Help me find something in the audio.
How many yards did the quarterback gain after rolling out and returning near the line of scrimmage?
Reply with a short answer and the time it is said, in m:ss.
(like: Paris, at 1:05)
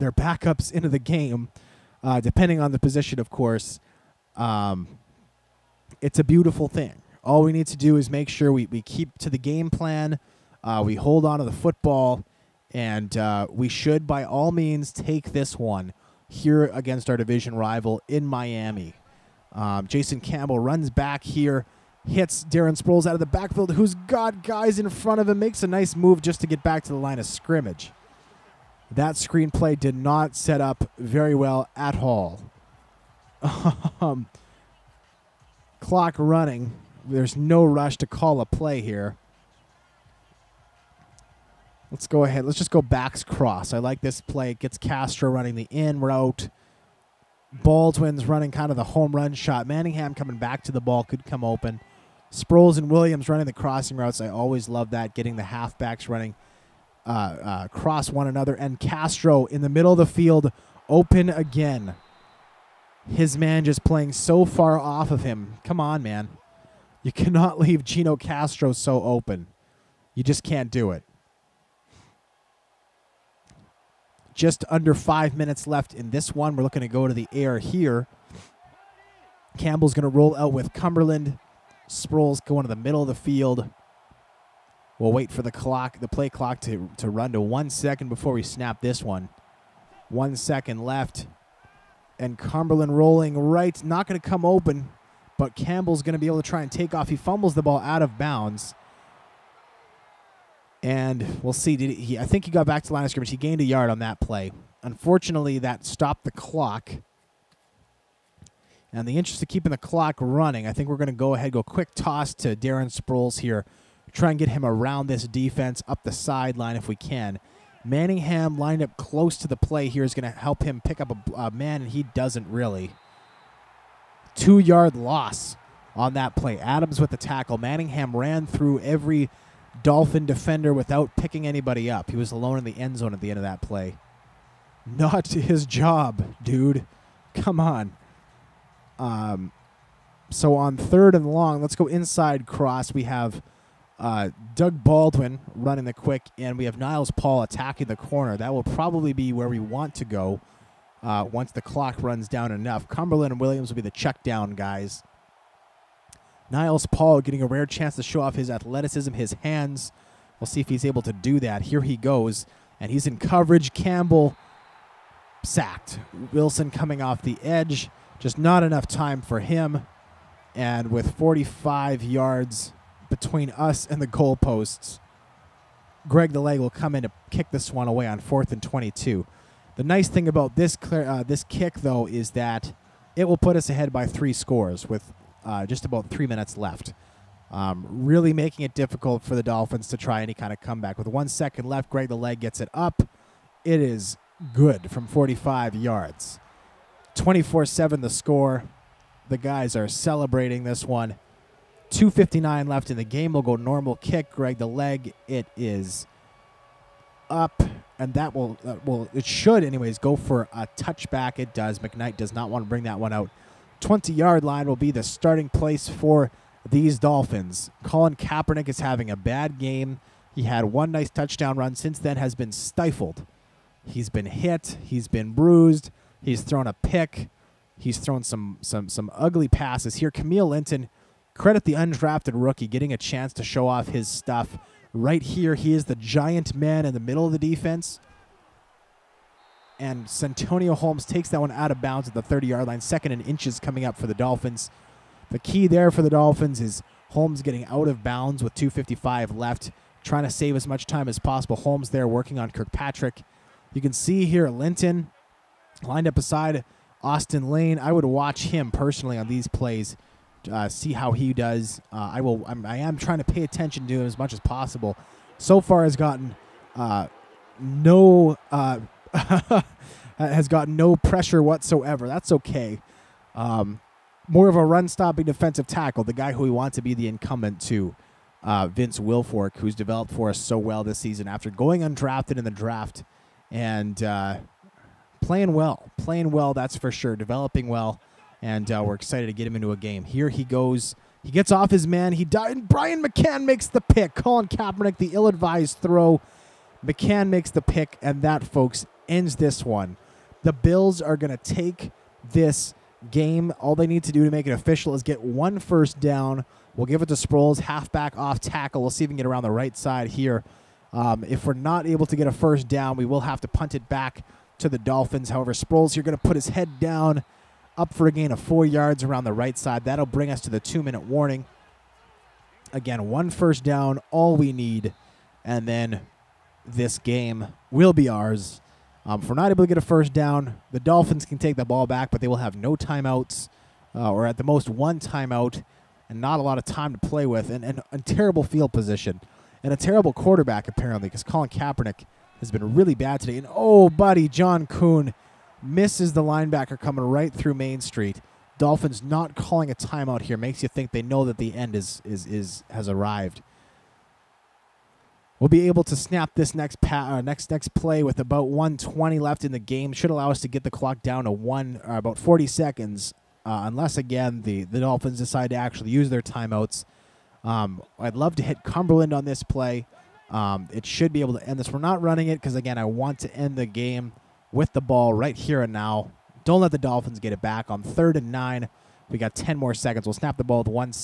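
1, at 1:43.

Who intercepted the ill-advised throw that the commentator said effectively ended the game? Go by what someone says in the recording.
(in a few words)
Brian McCann.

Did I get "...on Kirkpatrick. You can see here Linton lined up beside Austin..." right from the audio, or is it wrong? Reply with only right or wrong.
right.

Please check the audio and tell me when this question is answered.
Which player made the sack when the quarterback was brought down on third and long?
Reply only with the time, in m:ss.
2:46.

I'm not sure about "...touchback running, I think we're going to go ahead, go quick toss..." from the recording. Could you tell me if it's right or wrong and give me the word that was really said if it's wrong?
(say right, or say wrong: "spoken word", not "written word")
wrong: "clock", not "touchback".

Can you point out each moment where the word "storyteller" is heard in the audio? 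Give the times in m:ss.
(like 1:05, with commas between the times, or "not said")
not said.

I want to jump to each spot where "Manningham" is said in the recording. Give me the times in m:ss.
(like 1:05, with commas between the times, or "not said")
0:49, 1:57, 2:07.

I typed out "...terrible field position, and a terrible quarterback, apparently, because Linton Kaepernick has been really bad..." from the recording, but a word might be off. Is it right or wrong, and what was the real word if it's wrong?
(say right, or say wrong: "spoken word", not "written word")
wrong: "Colin", not "Linton".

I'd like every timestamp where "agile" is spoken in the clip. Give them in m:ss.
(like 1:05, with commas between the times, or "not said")
not said.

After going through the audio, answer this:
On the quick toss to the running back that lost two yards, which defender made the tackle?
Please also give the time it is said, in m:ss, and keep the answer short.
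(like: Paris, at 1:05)
Adams, at 2:06.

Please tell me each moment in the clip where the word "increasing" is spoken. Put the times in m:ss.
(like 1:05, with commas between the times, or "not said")
not said.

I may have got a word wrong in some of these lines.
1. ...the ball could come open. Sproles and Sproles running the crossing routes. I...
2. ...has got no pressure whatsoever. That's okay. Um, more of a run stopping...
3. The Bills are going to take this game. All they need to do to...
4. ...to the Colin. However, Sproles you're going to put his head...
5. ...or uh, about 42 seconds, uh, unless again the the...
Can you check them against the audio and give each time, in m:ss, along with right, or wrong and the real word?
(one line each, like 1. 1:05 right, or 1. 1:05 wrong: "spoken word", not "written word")
1. 0:50 wrong: "Williams", not "Sproles"
2. 4:30 right
3. 5:00 right
4. 5:14 wrong: "Dolphins", not "Colin"
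5. 6:01 wrong: "40", not "42".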